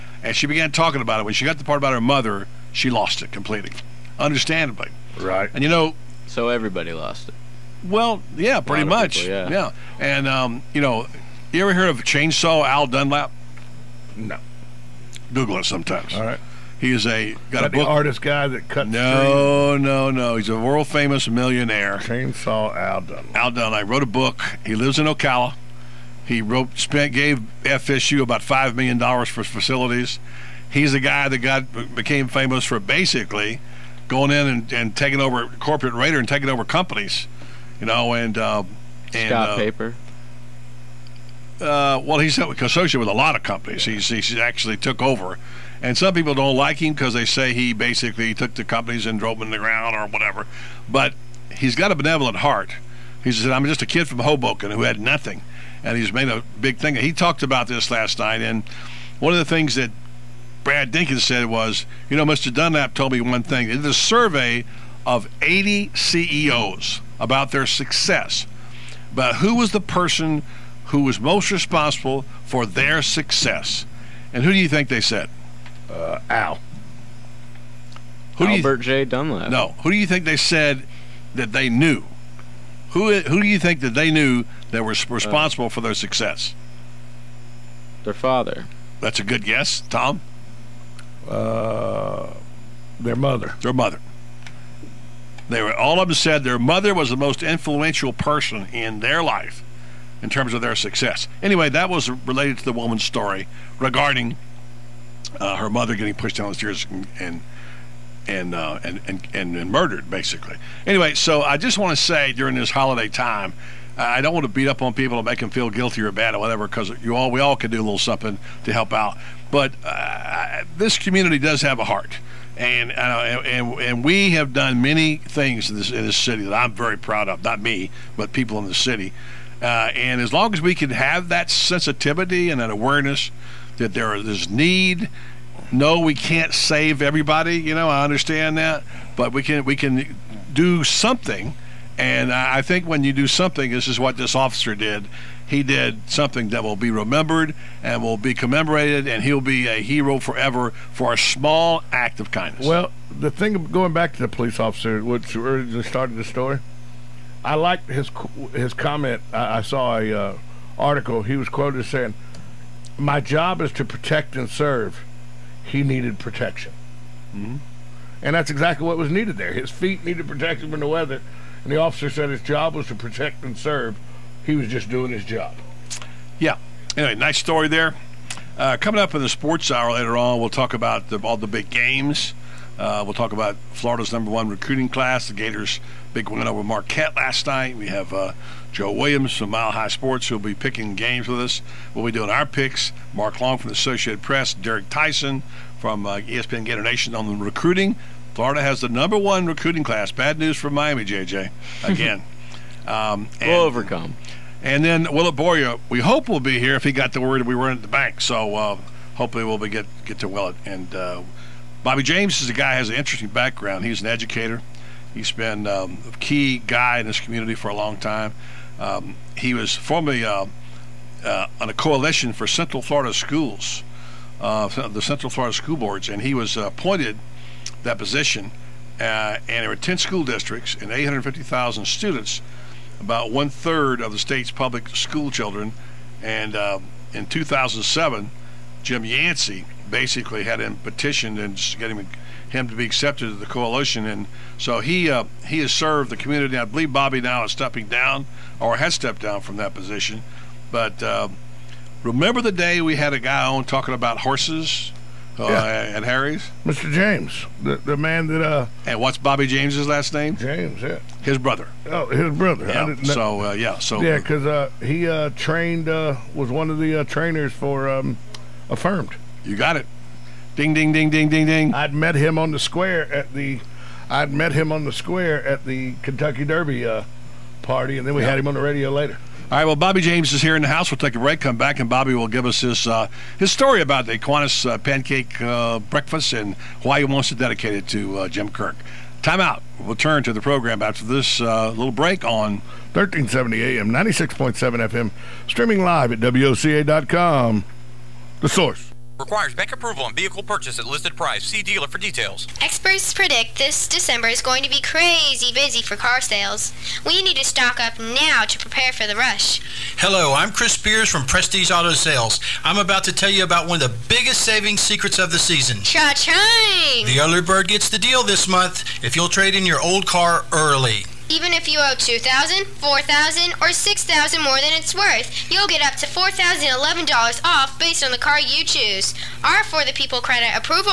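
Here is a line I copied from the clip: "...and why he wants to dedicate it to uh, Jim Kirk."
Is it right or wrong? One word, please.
right.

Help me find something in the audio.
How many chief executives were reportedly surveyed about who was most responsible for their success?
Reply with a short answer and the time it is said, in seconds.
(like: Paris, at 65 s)
80, at 65 s.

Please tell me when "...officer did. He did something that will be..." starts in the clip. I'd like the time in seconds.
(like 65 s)
144 s.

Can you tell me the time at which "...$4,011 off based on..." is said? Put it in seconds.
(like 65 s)
326 s.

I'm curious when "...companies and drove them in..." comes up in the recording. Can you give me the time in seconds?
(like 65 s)
48 s.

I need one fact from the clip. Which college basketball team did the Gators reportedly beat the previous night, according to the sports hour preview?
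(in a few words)
Marquette.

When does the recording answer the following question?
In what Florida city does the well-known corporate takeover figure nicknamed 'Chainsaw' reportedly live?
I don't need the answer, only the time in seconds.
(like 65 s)
25 s.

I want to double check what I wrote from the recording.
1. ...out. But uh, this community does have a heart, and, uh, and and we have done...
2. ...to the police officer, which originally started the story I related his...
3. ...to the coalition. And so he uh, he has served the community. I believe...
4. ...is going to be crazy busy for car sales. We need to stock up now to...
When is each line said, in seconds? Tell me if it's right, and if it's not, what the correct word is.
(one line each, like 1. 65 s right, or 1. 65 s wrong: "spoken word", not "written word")
1. 118 s right
2. 154 s wrong: "liked", not "related"
3. 243 s right
4. 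304 s right.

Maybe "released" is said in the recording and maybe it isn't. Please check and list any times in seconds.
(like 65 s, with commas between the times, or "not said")
not said.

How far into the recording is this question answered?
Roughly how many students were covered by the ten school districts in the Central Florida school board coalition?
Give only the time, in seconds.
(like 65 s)
230 s.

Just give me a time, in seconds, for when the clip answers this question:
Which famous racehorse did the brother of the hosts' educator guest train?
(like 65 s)
268 s.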